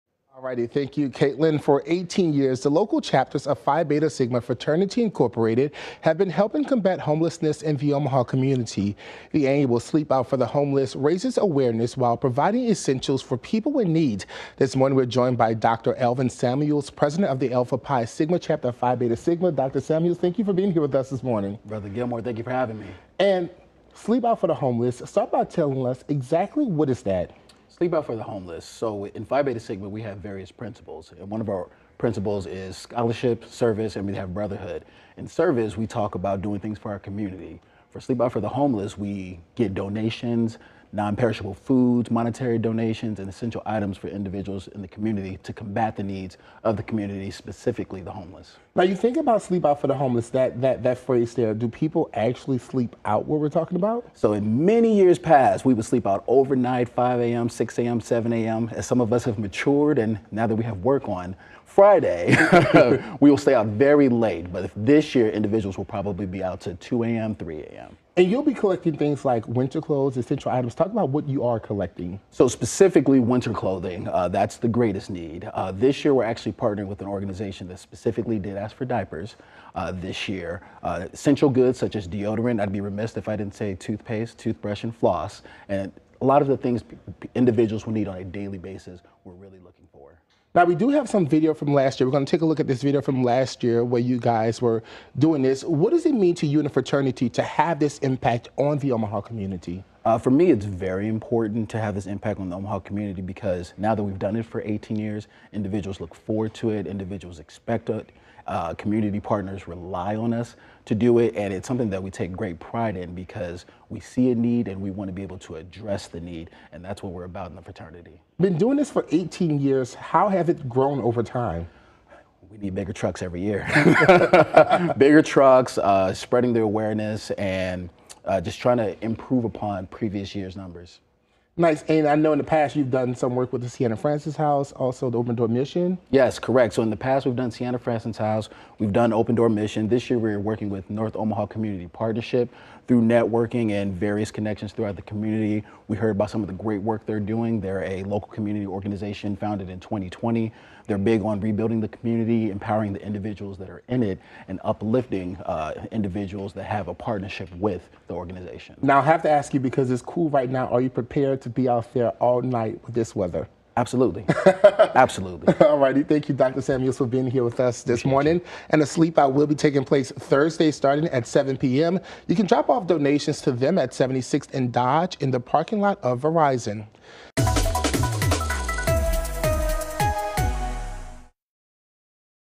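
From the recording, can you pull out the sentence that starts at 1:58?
Been doing this for 18 years.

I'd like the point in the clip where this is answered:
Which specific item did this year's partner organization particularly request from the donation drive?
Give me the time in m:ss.
1:18.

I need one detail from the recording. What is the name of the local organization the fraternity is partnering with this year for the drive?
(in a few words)
North Omaha Community Partnership.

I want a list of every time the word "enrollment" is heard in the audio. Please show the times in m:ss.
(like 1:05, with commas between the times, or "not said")
not said.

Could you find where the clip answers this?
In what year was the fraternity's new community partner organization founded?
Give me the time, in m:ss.
2:29.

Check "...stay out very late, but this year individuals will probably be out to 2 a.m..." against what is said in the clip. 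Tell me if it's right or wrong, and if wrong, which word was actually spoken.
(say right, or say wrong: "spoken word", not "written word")
right.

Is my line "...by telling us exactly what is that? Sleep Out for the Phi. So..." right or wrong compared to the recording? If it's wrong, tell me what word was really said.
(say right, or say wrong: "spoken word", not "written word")
wrong: "Homeless", not "Phi".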